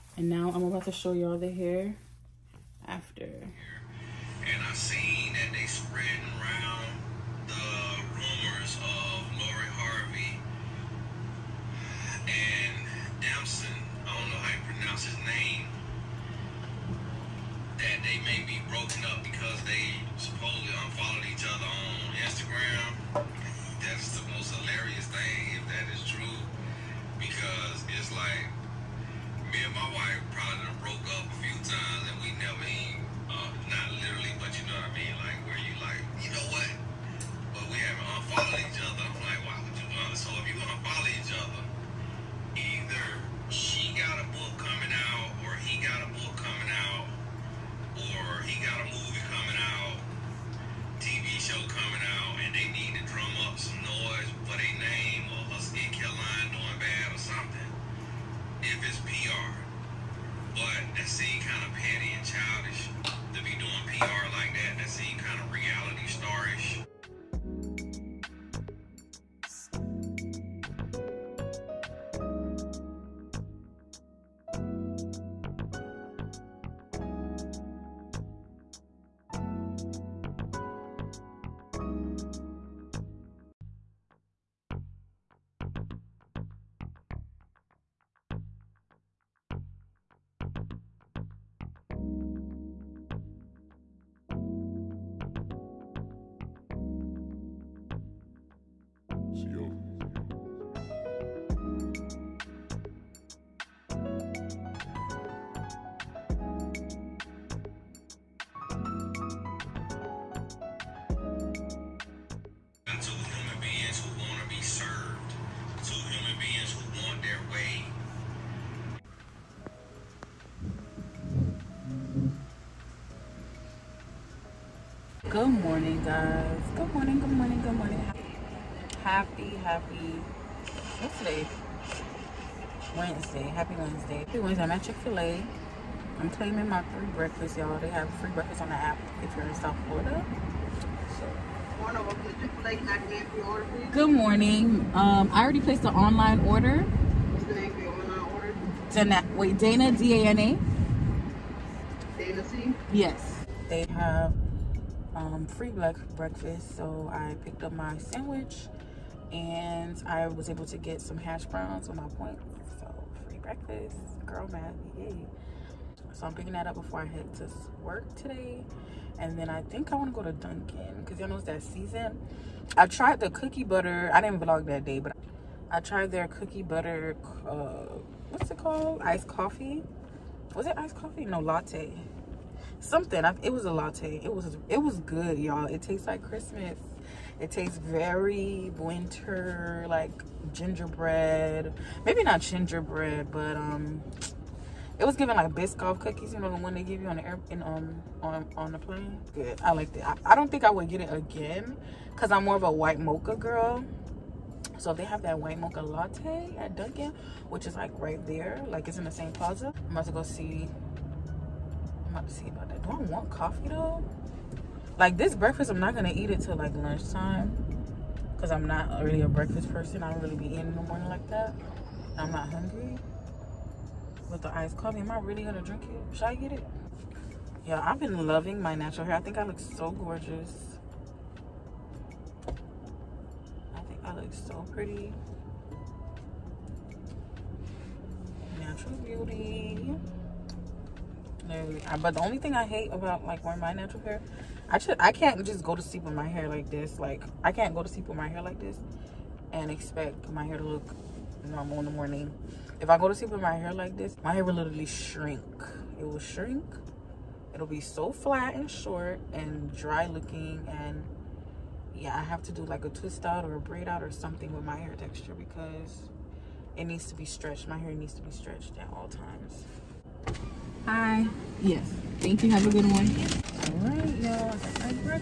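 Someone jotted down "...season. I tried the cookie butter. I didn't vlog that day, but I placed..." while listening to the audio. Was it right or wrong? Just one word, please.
wrong.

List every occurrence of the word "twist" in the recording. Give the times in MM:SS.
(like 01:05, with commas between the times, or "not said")
04:22.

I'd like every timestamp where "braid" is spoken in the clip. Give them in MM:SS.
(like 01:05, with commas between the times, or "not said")
04:23.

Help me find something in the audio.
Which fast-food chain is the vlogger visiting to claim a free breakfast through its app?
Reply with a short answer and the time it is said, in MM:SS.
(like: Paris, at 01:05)
Chick-fil-A, at 02:14.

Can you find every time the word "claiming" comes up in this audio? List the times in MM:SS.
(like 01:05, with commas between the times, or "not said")
02:16.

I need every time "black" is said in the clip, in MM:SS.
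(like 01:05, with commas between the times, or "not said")
02:35.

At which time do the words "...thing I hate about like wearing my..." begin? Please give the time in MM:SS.
04:02.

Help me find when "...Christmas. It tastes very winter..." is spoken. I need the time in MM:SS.
03:06.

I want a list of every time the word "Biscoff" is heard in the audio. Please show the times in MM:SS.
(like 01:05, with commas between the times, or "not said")
03:15.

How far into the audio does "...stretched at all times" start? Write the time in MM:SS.
04:28.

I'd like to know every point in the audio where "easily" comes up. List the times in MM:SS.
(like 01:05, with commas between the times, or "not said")
not said.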